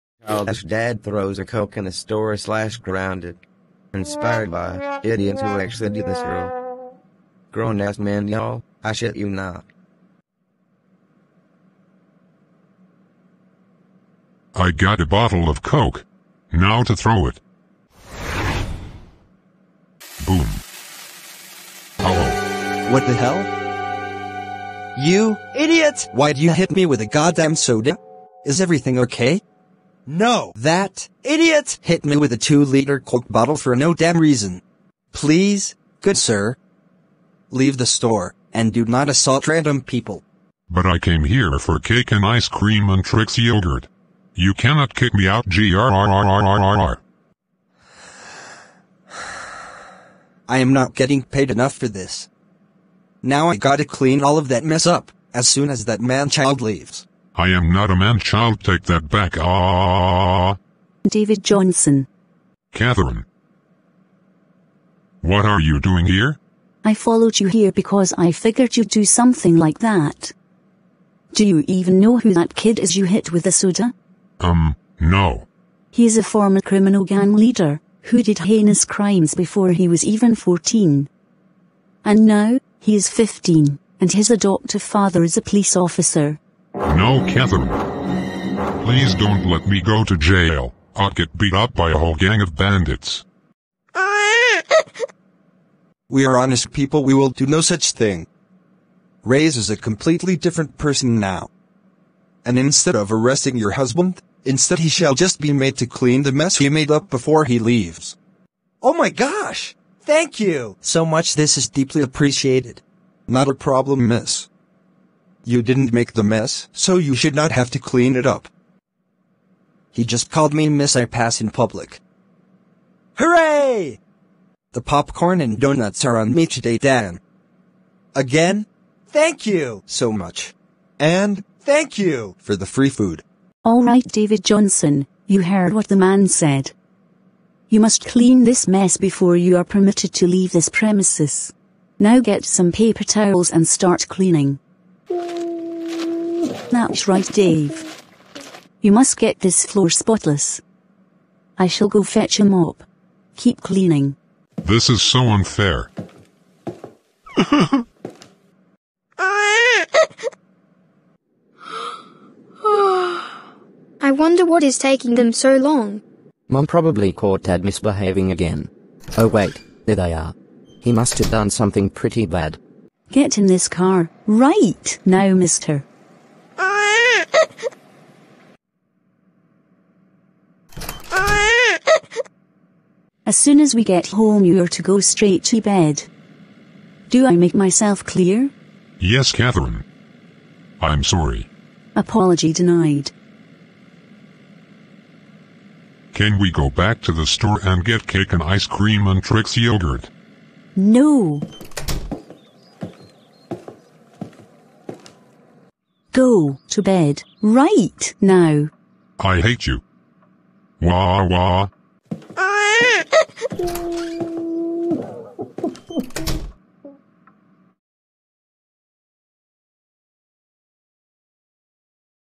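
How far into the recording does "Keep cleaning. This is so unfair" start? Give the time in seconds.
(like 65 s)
153 s.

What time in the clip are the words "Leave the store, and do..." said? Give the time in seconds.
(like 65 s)
37 s.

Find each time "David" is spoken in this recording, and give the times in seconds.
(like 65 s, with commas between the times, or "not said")
61 s, 134 s.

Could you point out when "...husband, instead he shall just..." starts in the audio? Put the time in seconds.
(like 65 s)
103 s.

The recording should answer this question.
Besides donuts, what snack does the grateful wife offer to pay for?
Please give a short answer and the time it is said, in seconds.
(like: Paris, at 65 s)
Popcorn, at 124 s.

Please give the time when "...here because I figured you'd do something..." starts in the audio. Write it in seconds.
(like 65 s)
67 s.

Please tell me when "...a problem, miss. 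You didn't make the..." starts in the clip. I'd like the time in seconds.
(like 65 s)
113 s.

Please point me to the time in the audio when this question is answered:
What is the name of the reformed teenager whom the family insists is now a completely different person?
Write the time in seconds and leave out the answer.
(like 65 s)
99 s.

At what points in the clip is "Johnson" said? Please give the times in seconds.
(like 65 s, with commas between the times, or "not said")
61 s, 134 s.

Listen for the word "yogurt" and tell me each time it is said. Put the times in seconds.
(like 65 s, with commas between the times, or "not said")
43 s, 199 s.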